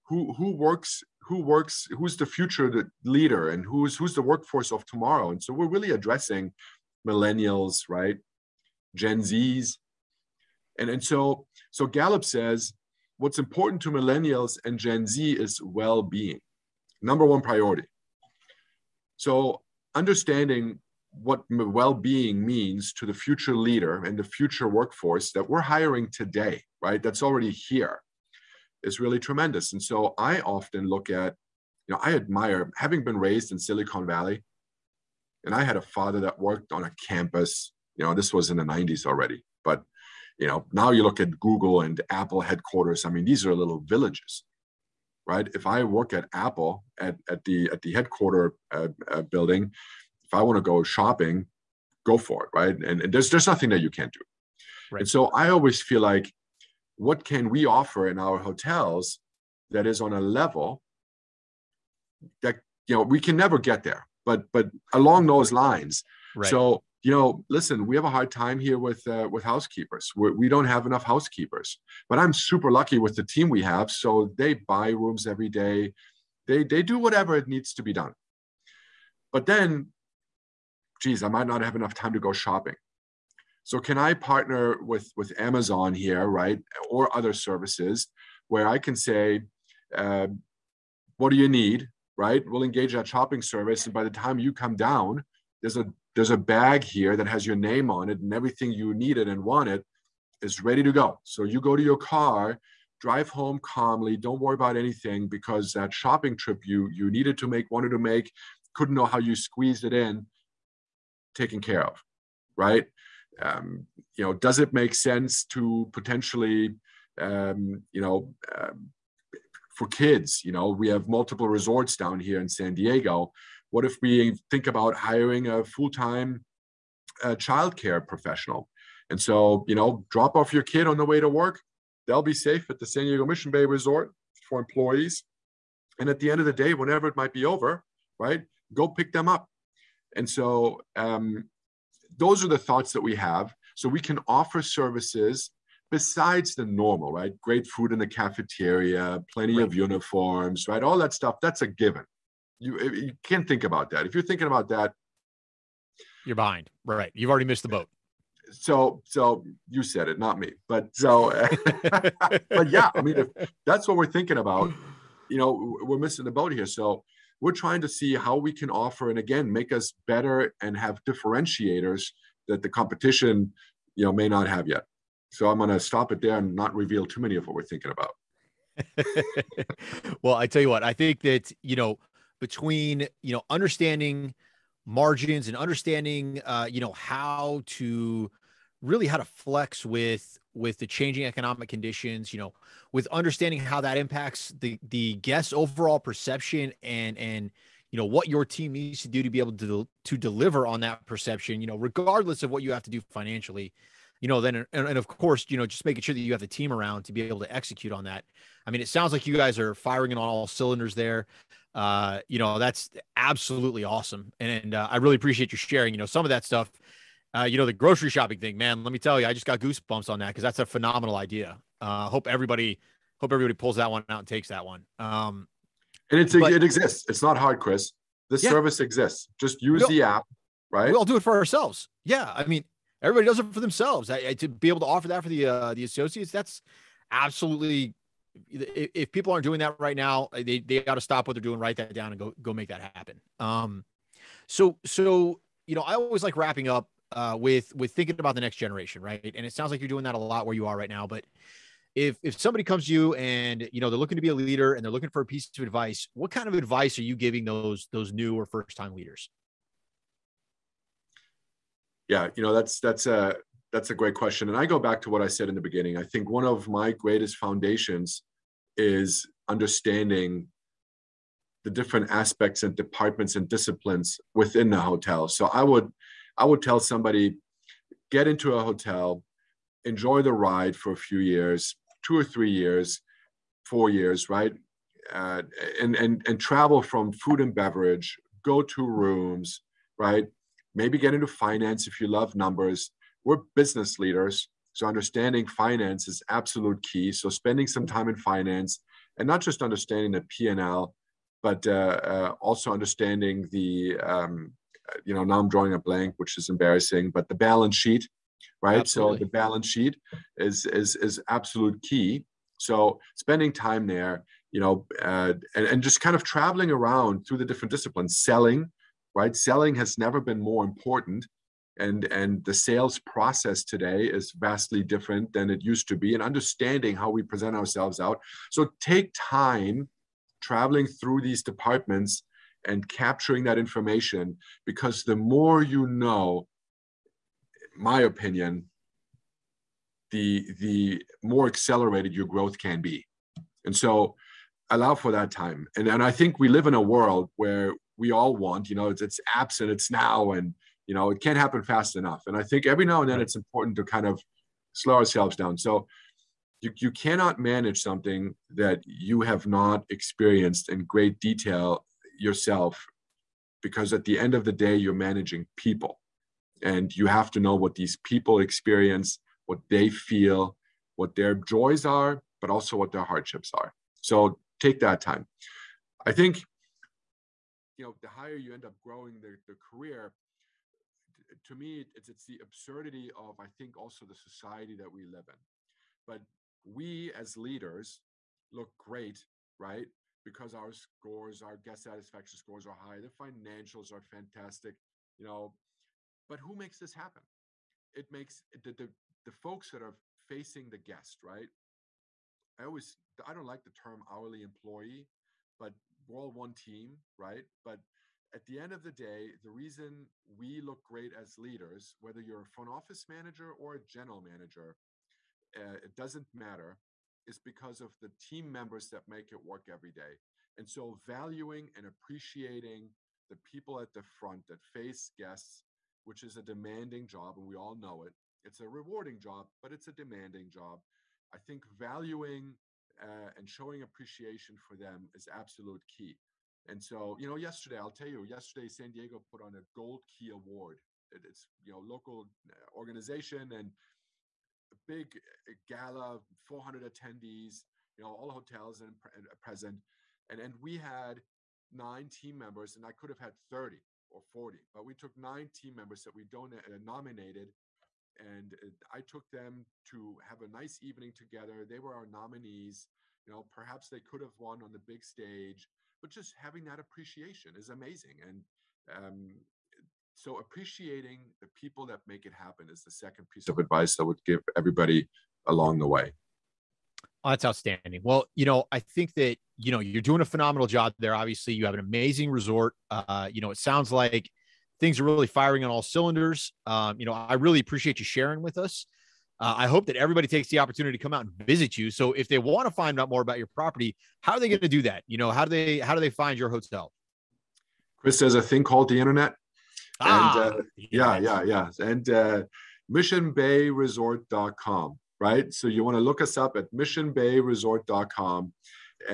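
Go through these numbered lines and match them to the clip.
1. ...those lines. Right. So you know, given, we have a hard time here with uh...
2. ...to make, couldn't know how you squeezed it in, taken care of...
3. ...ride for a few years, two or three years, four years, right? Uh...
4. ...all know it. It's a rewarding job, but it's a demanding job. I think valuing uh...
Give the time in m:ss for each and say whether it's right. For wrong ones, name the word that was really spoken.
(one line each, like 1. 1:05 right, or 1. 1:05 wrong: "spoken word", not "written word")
1. 1:05 wrong: "listen", not "given"
2. 1:47 right
3. 4:40 right
4. 7:07 right.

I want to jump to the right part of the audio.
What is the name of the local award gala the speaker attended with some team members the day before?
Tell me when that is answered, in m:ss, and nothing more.
7:19.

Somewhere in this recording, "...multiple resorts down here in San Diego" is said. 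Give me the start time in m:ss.
2:01.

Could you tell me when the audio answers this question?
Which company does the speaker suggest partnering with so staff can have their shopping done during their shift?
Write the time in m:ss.
1:25.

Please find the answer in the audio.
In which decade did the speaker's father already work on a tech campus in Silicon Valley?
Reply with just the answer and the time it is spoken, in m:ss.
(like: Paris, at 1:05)
1990s, at 0:38.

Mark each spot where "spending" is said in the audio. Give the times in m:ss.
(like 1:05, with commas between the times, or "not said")
4:57, 5:13.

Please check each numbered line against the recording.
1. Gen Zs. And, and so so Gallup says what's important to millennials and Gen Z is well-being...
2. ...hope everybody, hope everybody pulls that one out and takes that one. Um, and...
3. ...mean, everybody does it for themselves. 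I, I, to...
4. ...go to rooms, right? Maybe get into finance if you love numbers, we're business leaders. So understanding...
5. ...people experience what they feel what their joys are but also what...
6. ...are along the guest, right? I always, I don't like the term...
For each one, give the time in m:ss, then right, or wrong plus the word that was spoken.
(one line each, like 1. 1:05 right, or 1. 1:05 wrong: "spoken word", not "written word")
1. 0:08 right
2. 3:42 right
3. 3:52 right
4. 4:48 right
5. 6:08 right
6. 6:39 wrong: "facing", not "along".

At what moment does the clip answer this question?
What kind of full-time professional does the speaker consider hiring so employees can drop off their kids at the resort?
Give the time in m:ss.
2:07.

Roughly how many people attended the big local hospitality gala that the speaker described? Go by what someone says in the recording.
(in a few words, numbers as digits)
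400.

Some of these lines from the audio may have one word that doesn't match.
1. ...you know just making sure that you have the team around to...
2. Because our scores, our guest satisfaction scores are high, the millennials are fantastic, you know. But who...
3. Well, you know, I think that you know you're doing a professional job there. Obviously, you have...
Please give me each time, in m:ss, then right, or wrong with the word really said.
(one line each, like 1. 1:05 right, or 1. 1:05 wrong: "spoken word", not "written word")
1. 3:25 right
2. 6:30 wrong: "financials", not "millennials"
3. 7:58 wrong: "phenomenal", not "professional".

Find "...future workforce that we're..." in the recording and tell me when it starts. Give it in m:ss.
0:24.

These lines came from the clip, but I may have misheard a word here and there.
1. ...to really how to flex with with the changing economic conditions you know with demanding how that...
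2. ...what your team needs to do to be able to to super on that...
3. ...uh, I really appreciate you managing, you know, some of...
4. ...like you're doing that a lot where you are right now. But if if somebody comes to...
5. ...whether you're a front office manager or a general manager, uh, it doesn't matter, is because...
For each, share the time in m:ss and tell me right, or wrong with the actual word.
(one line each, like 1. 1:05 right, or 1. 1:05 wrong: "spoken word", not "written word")
1. 3:07 wrong: "understanding", not "demanding"
2. 3:18 wrong: "deliver", not "super"
3. 3:34 wrong: "sharing", not "managing"
4. 4:09 right
5. 6:51 right.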